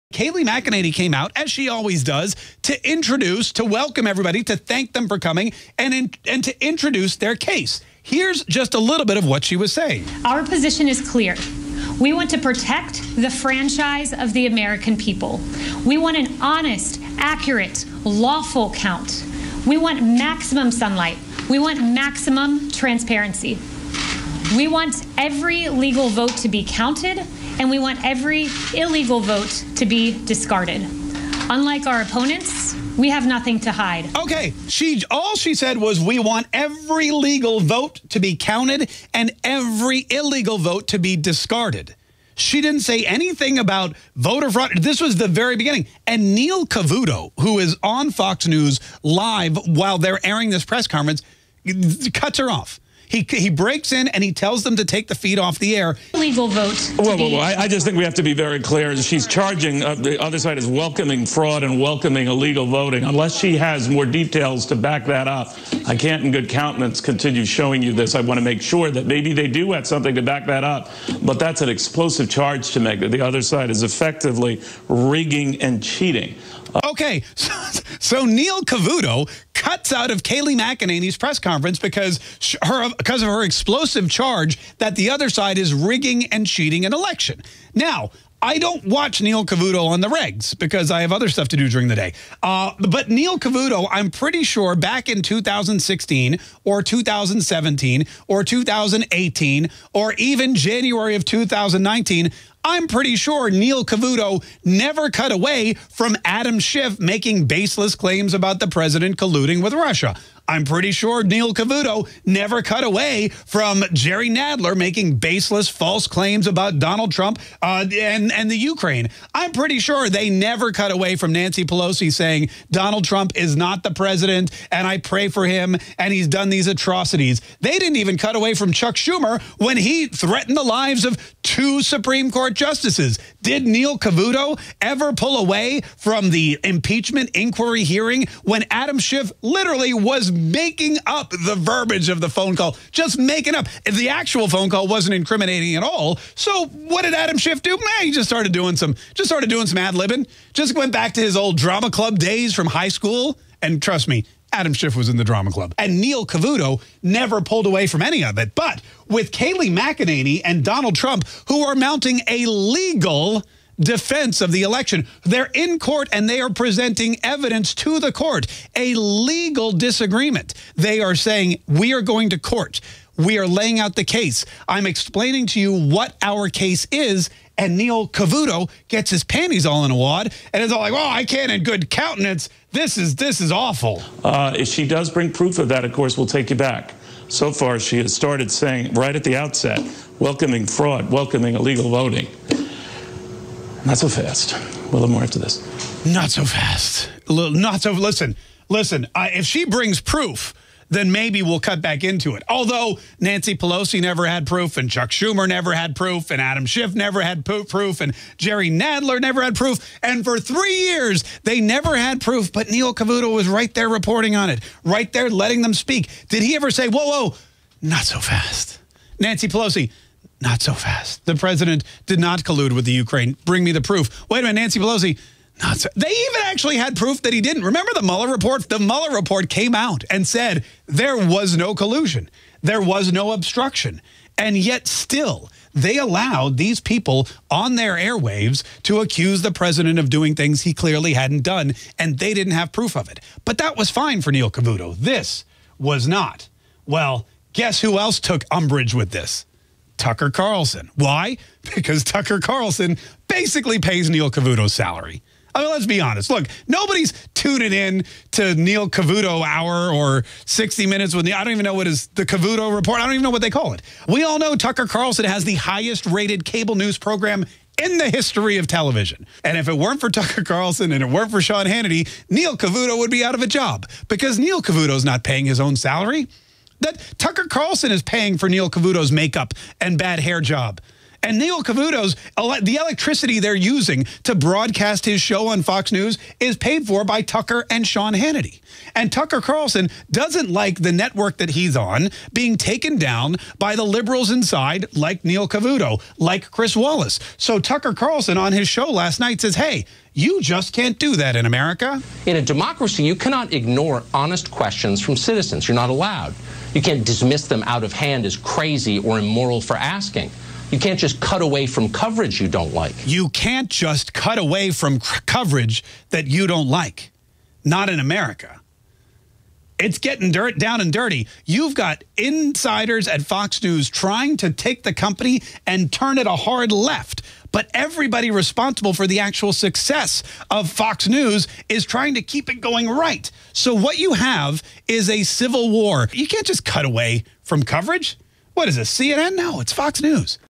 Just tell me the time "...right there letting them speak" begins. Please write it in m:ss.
3:34.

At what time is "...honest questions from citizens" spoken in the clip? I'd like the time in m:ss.
5:04.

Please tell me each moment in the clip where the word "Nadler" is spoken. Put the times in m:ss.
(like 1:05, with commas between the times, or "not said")
1:54, 3:28.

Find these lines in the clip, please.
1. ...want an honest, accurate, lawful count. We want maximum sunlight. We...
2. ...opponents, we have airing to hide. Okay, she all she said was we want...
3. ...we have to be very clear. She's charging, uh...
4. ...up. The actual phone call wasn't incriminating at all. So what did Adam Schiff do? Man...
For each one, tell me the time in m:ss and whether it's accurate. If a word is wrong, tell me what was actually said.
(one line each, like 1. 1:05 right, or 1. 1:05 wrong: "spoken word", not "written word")
1. 0:15 right
2. 0:32 wrong: "nothing", not "airing"
3. 0:57 right
4. 2:23 right.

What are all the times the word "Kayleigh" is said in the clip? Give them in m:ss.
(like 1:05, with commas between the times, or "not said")
0:00, 1:20, 2:39.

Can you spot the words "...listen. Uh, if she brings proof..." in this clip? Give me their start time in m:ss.
3:18.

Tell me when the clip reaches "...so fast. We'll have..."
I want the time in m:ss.
3:13.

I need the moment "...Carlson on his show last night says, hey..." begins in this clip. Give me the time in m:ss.
4:57.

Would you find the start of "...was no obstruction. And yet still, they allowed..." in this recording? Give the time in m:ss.
3:52.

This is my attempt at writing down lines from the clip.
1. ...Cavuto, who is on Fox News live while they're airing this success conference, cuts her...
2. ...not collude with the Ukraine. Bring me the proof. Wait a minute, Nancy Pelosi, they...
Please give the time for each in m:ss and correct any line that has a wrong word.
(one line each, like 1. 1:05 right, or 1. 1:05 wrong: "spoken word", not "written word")
1. 0:46 wrong: "press", not "success"
2. 3:42 right.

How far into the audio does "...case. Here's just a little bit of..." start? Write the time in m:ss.
0:07.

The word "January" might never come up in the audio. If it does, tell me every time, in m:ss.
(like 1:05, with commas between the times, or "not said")
1:40.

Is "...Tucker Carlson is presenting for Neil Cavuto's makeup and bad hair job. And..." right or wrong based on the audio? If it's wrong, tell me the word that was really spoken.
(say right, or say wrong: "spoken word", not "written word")
wrong: "paying", not "presenting".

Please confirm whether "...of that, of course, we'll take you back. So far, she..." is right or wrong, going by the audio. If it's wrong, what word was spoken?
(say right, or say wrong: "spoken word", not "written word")
right.